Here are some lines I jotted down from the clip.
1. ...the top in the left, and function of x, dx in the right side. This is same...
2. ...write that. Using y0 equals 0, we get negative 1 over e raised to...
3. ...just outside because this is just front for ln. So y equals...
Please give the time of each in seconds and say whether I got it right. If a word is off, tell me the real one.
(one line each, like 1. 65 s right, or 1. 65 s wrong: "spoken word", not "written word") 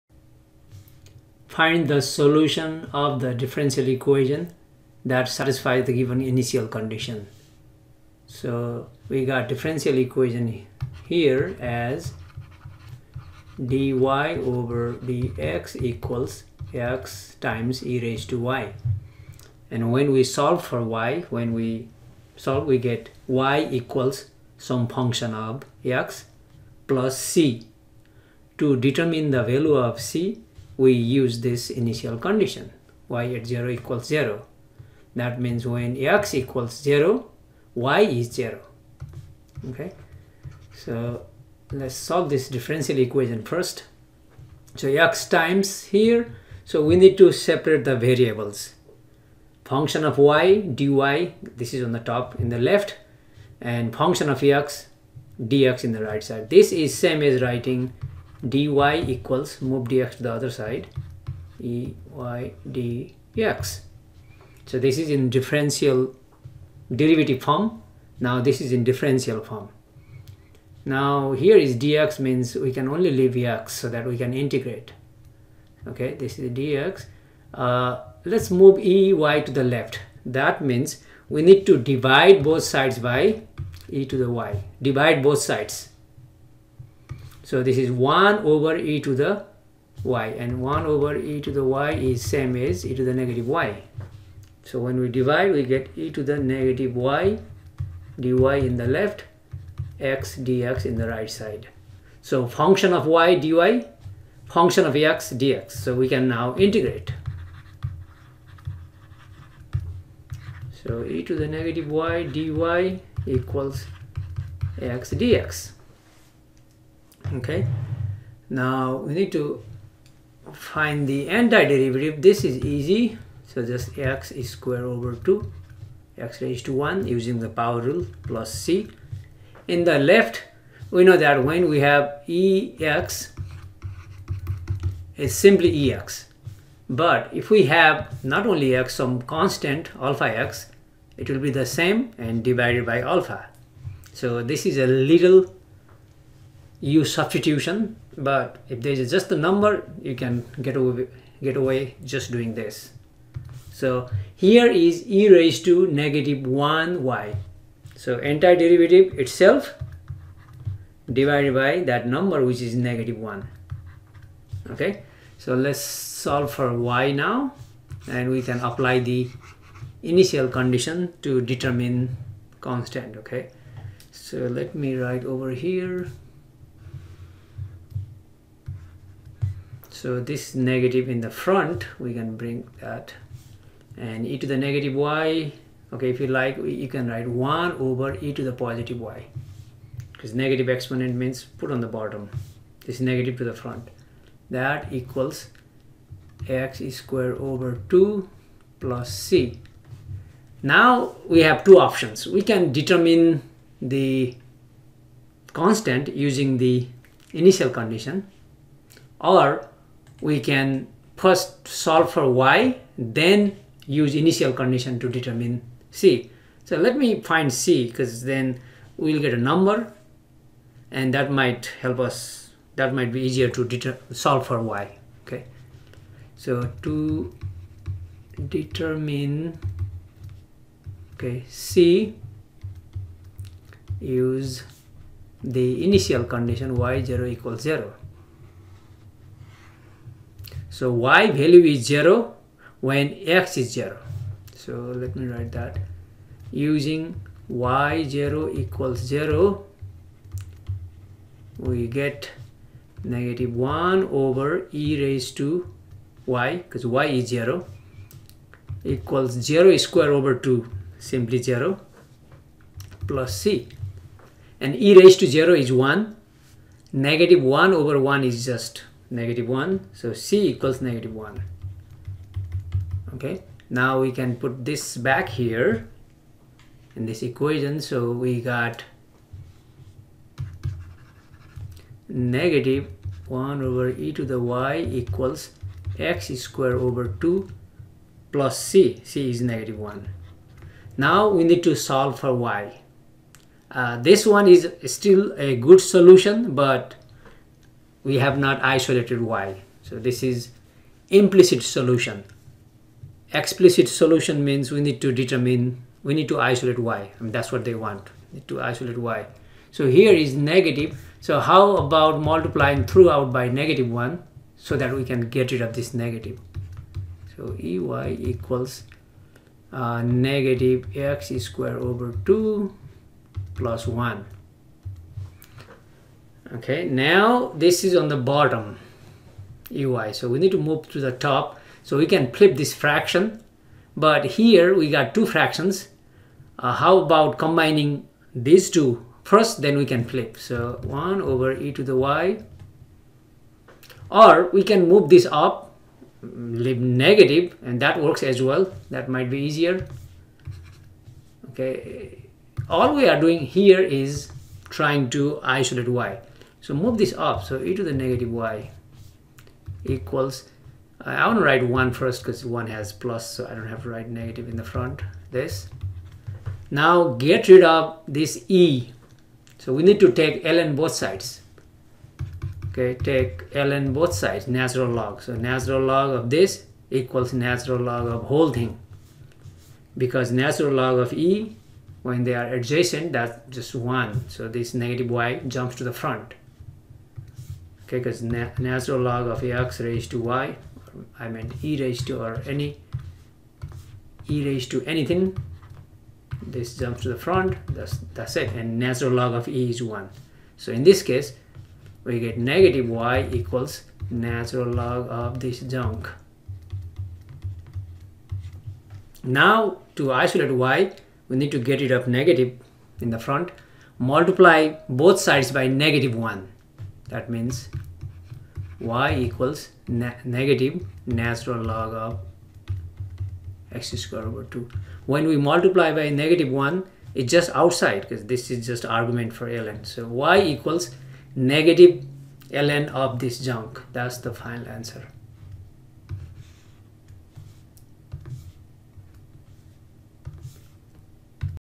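1. 51 s right
2. 245 s right
3. 427 s wrong: "argument", not "front".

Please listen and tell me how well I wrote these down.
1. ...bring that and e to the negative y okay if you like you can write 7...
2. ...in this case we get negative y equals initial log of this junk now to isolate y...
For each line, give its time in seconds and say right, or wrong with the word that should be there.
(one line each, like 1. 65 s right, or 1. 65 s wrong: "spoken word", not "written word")
1. 182 s wrong: "1", not "7"
2. 400 s wrong: "natural", not "initial".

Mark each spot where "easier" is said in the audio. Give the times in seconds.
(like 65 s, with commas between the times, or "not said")
223 s, 349 s.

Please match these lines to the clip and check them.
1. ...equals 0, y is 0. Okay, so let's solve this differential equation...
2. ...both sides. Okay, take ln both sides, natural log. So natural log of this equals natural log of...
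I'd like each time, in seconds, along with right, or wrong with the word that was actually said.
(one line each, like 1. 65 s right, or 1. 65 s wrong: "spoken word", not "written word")
1. 36 s right
2. 370 s right.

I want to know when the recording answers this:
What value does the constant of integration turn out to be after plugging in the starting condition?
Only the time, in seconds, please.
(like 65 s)
270 s.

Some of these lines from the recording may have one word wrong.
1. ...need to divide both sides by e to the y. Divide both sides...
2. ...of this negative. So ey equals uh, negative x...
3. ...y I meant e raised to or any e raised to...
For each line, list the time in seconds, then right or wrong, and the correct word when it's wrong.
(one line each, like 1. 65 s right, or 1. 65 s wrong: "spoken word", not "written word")
1. 81 s right
2. 315 s right
3. 390 s right.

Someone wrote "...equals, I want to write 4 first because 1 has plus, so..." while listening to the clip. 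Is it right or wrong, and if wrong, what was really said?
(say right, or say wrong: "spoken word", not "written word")
wrong: "1", not "4".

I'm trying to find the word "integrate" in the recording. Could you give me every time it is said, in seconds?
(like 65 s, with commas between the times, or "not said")
74 s, 106 s.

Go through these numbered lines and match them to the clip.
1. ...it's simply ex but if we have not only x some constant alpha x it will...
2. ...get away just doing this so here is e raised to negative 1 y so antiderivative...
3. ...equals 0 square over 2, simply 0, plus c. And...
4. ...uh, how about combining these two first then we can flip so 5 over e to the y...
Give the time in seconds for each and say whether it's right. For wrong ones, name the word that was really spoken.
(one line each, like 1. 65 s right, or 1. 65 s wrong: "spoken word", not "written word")
1. 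135 s right
2. 151 s right
3. 258 s right
4. 336 s wrong: "1", not "5".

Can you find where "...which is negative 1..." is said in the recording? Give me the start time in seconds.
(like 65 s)
162 s.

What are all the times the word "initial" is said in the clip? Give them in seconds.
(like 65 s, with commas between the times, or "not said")
6 s, 31 s, 170 s, 207 s, 214 s, 235 s.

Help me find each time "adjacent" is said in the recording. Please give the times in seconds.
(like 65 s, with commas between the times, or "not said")
382 s.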